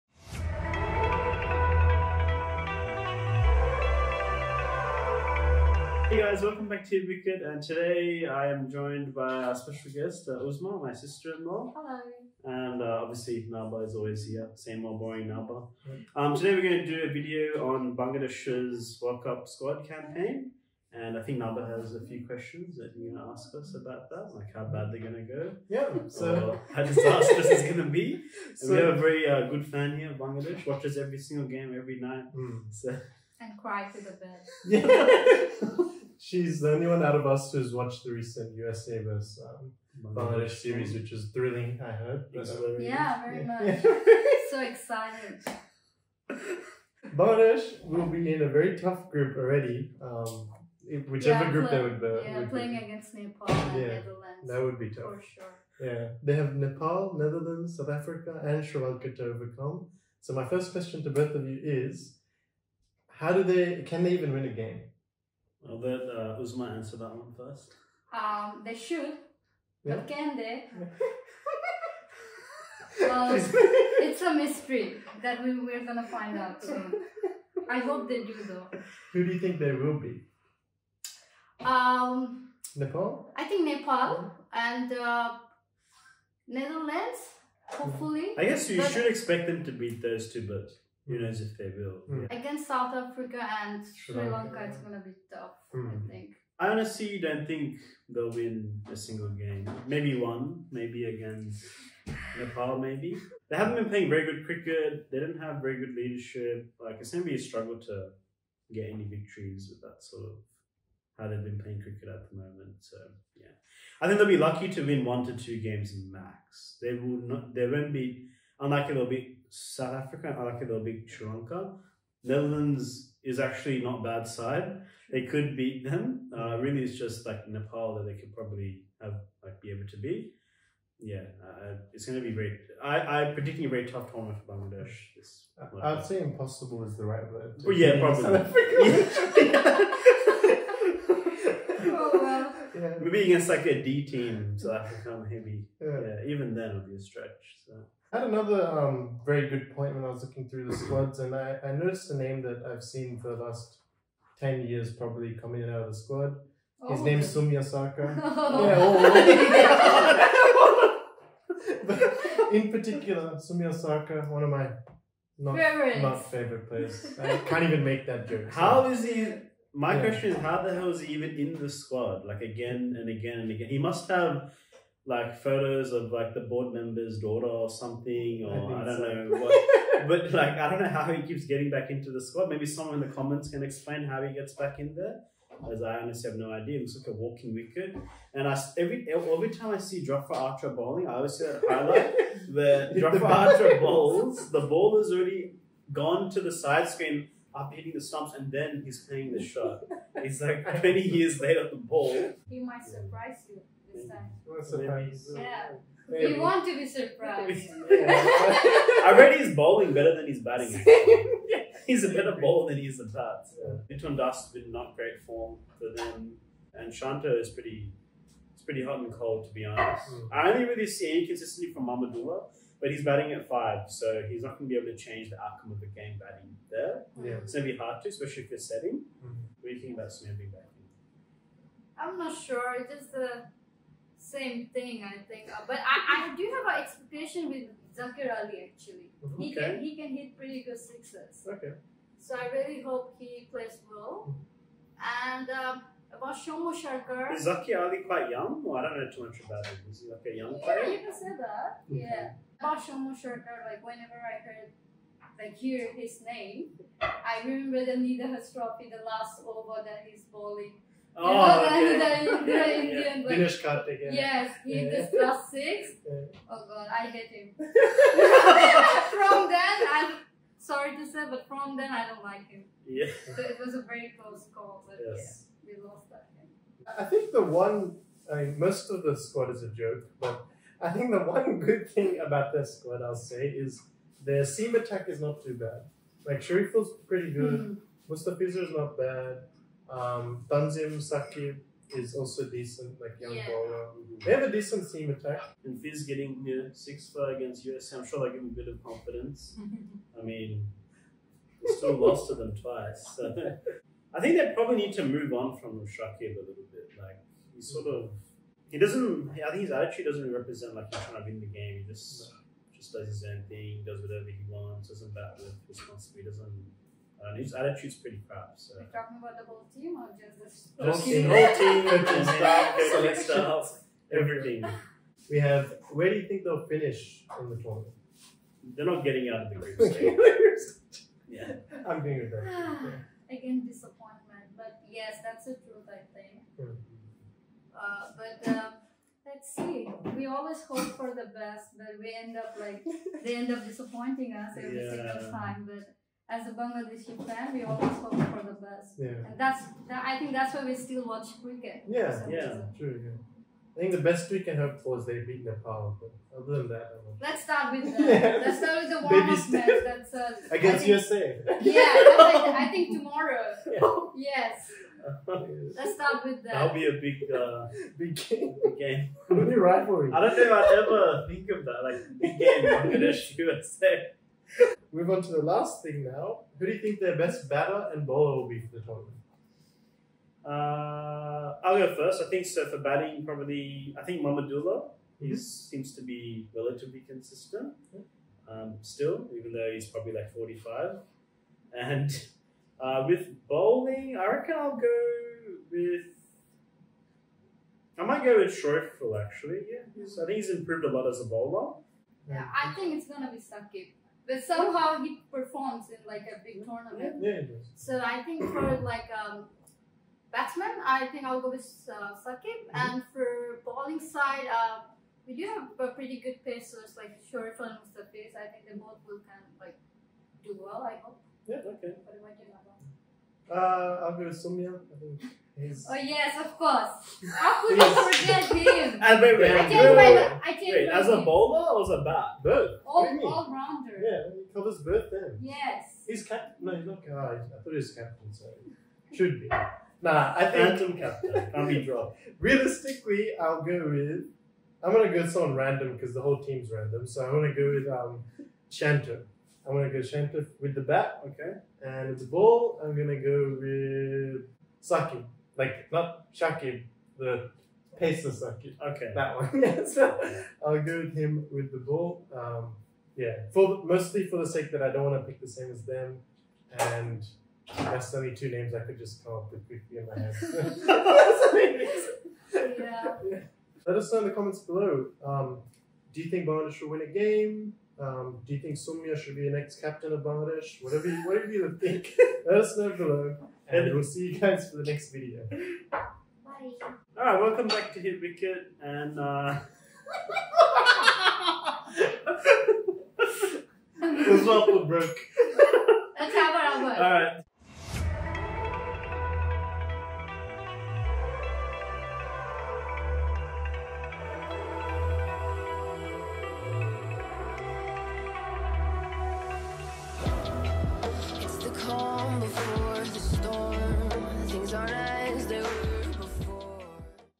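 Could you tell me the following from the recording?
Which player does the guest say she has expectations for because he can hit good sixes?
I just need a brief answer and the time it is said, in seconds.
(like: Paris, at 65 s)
Zakir Ali, at 237 s.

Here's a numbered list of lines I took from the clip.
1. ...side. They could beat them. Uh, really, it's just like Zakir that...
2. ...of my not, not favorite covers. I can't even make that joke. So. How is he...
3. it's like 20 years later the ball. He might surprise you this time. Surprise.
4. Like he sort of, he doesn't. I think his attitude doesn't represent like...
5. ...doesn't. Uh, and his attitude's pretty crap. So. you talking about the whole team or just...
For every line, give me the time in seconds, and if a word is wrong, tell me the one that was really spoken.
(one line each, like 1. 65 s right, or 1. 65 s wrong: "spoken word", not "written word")
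1. 124 s wrong: "Nepal", not "Zakir"
2. 164 s wrong: "players", not "covers"
3. 200 s right
4. 307 s right
5. 316 s right.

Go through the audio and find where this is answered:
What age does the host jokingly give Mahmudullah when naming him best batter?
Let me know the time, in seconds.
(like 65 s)
390 s.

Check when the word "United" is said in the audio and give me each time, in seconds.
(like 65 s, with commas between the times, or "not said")
91 s.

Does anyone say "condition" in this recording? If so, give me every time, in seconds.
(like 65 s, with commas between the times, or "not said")
not said.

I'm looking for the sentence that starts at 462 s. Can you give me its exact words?
Um, yeah, for mostly for the sake that I don't want to pick the same as them.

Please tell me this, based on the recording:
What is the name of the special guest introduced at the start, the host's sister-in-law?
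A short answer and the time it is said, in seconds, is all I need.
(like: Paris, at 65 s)
Uzma, at 10 s.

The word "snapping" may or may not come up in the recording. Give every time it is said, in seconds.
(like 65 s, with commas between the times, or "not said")
230 s.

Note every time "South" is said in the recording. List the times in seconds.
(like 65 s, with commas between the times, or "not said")
57 s, 92 s, 119 s.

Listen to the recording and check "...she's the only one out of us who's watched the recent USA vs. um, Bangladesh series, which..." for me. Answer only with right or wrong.
right.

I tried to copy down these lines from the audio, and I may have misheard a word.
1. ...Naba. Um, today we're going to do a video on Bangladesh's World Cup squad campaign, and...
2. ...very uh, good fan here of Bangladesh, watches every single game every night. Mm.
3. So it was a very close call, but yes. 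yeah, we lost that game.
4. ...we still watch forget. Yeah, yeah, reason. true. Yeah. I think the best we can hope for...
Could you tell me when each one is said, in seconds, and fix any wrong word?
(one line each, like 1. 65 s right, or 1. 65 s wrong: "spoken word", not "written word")
1. 15 s right
2. 28 s right
3. 273 s right
4. 350 s wrong: "cricket", not "forget".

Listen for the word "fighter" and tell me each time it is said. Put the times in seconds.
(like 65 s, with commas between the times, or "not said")
not said.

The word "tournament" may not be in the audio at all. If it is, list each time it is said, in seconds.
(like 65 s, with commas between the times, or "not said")
134 s, 327 s, 378 s, 406 s.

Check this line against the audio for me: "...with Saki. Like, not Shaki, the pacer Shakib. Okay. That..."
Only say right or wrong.
wrong.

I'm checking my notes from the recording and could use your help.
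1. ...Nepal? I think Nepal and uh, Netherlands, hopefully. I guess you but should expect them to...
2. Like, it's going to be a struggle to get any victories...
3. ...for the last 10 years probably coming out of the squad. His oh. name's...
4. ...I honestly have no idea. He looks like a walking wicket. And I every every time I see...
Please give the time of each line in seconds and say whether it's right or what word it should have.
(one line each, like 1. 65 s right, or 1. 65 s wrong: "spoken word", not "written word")
1. 82 s right
2. 106 s right
3. 153 s right
4. 185 s right.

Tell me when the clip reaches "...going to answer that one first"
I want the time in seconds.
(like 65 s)
66 s.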